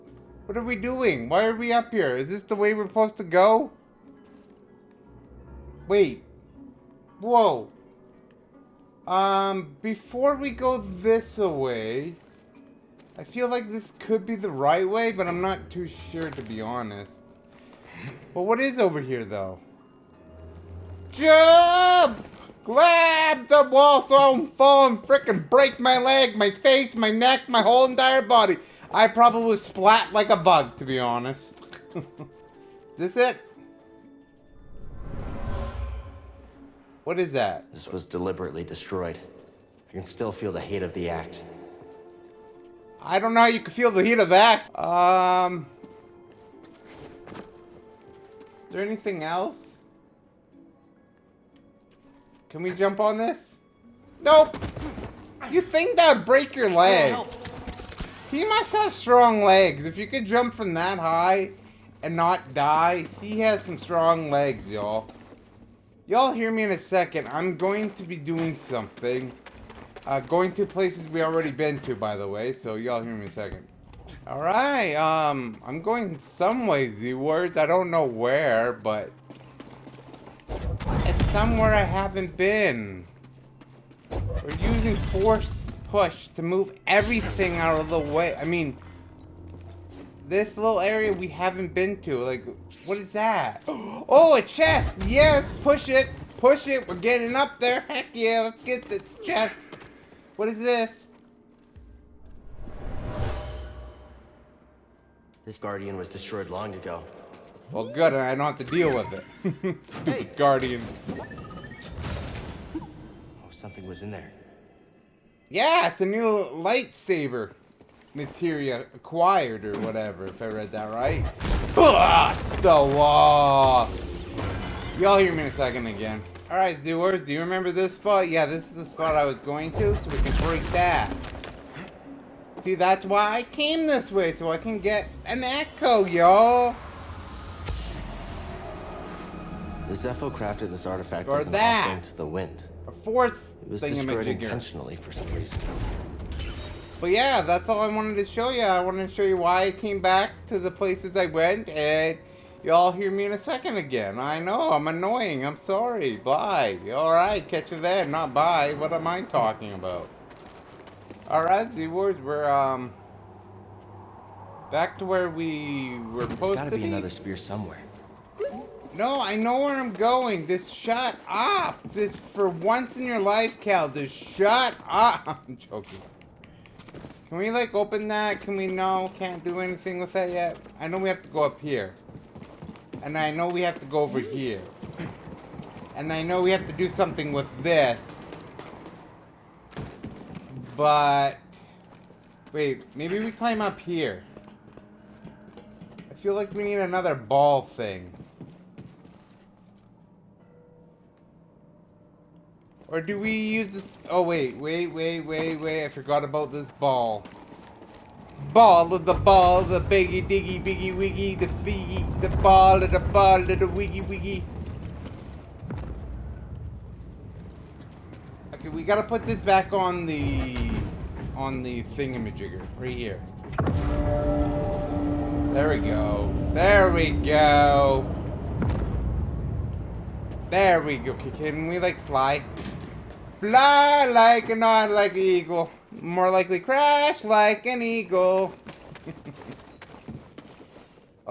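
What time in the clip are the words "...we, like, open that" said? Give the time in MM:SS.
02:57.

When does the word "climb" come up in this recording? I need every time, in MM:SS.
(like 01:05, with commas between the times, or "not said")
03:13.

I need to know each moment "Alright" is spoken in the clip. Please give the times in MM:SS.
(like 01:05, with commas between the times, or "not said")
01:14, 02:06, 02:36, 02:41.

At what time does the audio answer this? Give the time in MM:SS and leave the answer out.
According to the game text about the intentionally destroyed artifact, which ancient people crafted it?
02:19.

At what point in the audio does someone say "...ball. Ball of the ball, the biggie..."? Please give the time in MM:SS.
03:26.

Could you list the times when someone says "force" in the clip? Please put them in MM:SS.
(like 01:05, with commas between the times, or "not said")
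01:24, 02:23.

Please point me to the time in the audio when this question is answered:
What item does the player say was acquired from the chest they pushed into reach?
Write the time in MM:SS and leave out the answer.
01:56.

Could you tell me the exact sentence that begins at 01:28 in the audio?
I mean, this little area we haven't been to.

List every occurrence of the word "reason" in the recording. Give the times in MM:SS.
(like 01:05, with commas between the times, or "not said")
02:25.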